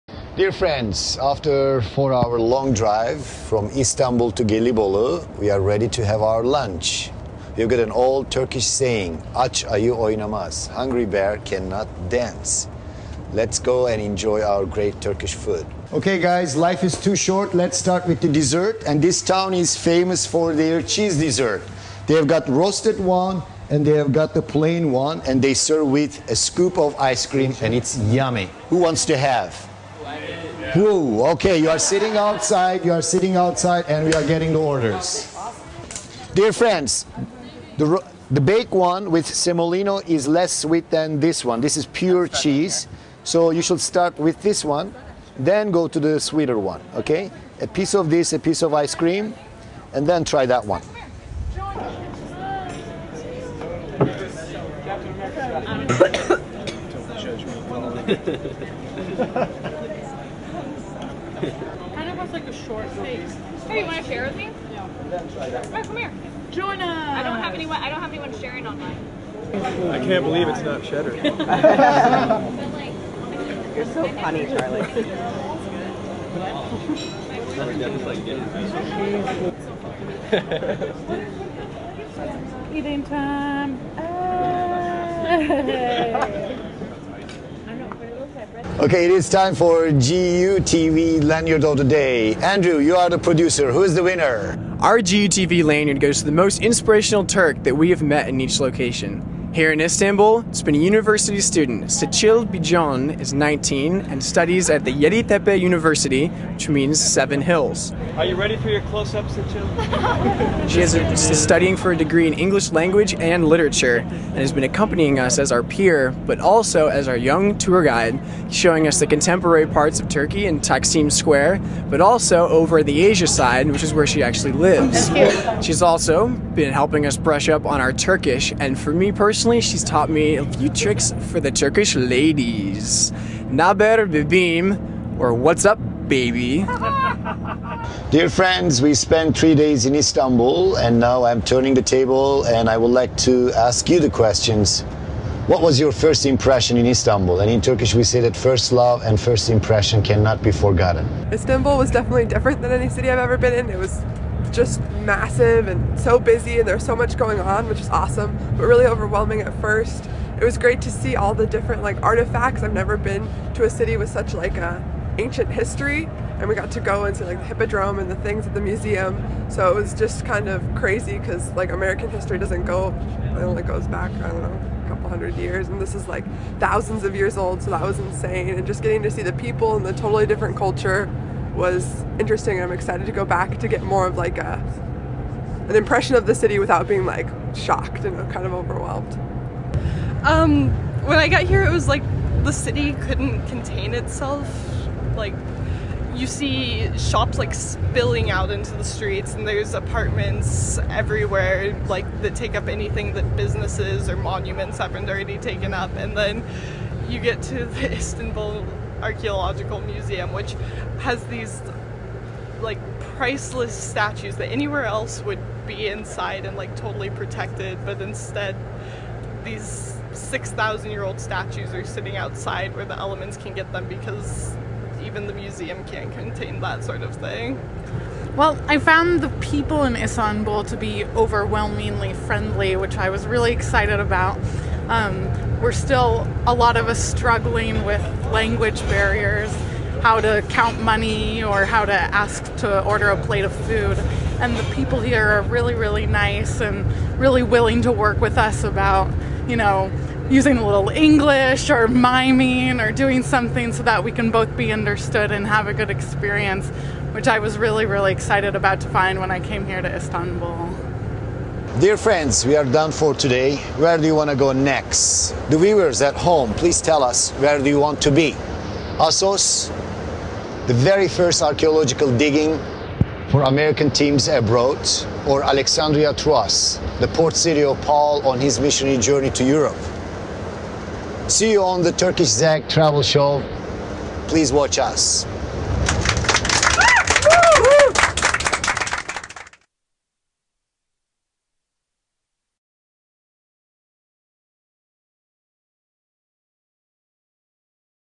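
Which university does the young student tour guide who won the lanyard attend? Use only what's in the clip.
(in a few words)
Yeditepe University.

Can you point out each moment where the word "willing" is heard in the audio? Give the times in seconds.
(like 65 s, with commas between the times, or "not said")
247 s.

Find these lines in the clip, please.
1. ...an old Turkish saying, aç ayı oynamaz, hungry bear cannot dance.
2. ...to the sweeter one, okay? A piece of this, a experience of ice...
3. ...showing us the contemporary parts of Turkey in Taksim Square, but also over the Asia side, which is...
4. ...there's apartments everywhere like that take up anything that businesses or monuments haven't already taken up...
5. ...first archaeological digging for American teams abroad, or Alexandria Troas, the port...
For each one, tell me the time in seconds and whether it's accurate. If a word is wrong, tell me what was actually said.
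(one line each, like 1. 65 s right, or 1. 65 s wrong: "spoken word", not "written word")
1. 7 s right
2. 45 s wrong: "piece", not "experience"
3. 118 s right
4. 199 s right
5. 271 s right.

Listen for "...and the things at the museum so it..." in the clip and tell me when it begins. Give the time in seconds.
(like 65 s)
167 s.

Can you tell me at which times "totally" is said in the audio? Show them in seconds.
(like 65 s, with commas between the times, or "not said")
179 s, 216 s.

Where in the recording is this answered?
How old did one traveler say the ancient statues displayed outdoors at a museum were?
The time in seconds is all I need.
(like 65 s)
220 s.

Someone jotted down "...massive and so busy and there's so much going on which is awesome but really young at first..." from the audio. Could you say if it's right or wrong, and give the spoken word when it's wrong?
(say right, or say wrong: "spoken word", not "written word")
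wrong: "overwhelming", not "young".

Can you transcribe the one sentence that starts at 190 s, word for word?
Um, when I got here, it was like the city couldn't contain itself.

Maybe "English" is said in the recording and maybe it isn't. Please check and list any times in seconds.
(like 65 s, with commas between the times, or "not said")
112 s, 250 s.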